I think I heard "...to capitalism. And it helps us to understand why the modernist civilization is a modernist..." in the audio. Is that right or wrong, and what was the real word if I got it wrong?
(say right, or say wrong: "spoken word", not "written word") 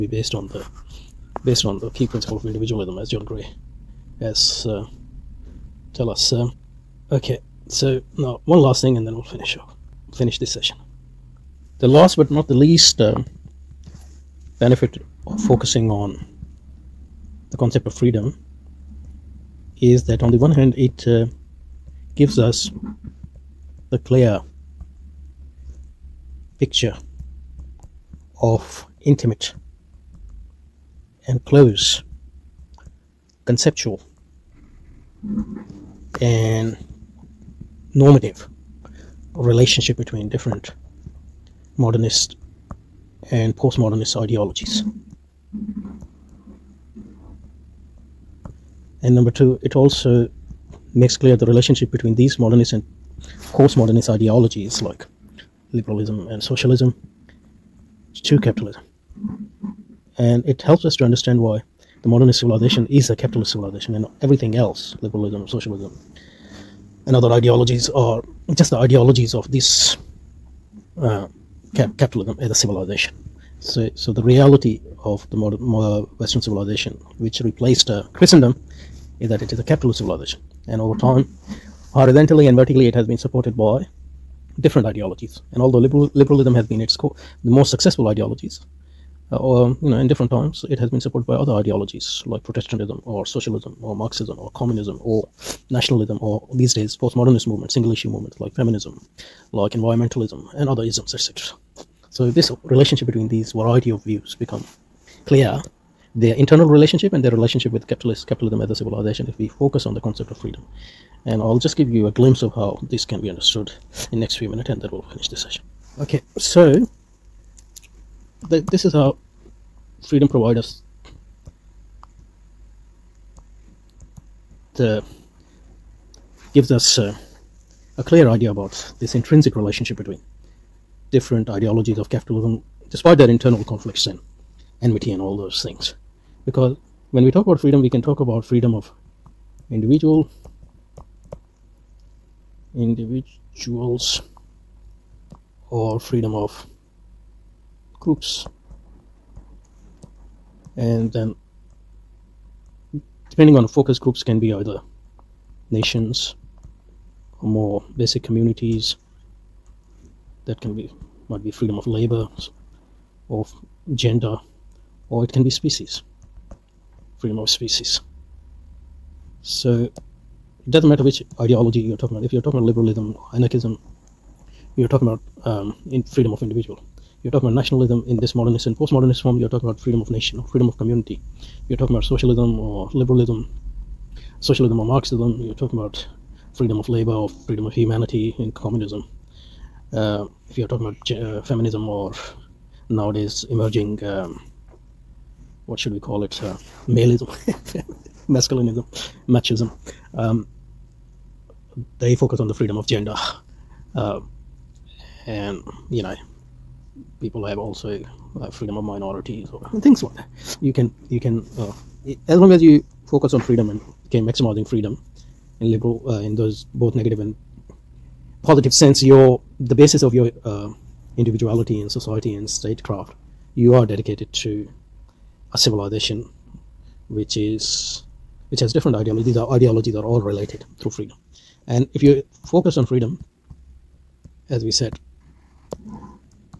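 wrong: "capitalist", not "modernist".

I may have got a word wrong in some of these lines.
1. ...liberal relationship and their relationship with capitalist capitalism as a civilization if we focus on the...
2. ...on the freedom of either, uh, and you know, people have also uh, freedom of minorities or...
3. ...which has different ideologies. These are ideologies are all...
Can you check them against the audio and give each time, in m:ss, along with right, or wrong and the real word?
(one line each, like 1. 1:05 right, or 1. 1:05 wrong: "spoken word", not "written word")
1. 1:46 wrong: "internal", not "liberal"
2. 3:22 wrong: "gender", not "either"
3. 3:48 right.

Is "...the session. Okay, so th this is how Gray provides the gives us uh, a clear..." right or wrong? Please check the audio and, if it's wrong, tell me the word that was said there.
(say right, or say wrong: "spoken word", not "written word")
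wrong: "Freedom", not "Gray".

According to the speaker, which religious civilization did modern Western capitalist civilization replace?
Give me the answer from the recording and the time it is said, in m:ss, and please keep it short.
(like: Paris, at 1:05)
Christendom, at 1:18.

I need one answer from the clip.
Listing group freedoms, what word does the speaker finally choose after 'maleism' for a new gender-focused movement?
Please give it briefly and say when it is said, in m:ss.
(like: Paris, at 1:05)
masculinism, at 3:18.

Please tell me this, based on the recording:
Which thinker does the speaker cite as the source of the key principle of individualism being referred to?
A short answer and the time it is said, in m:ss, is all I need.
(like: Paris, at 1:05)
John Gray, at 0:03.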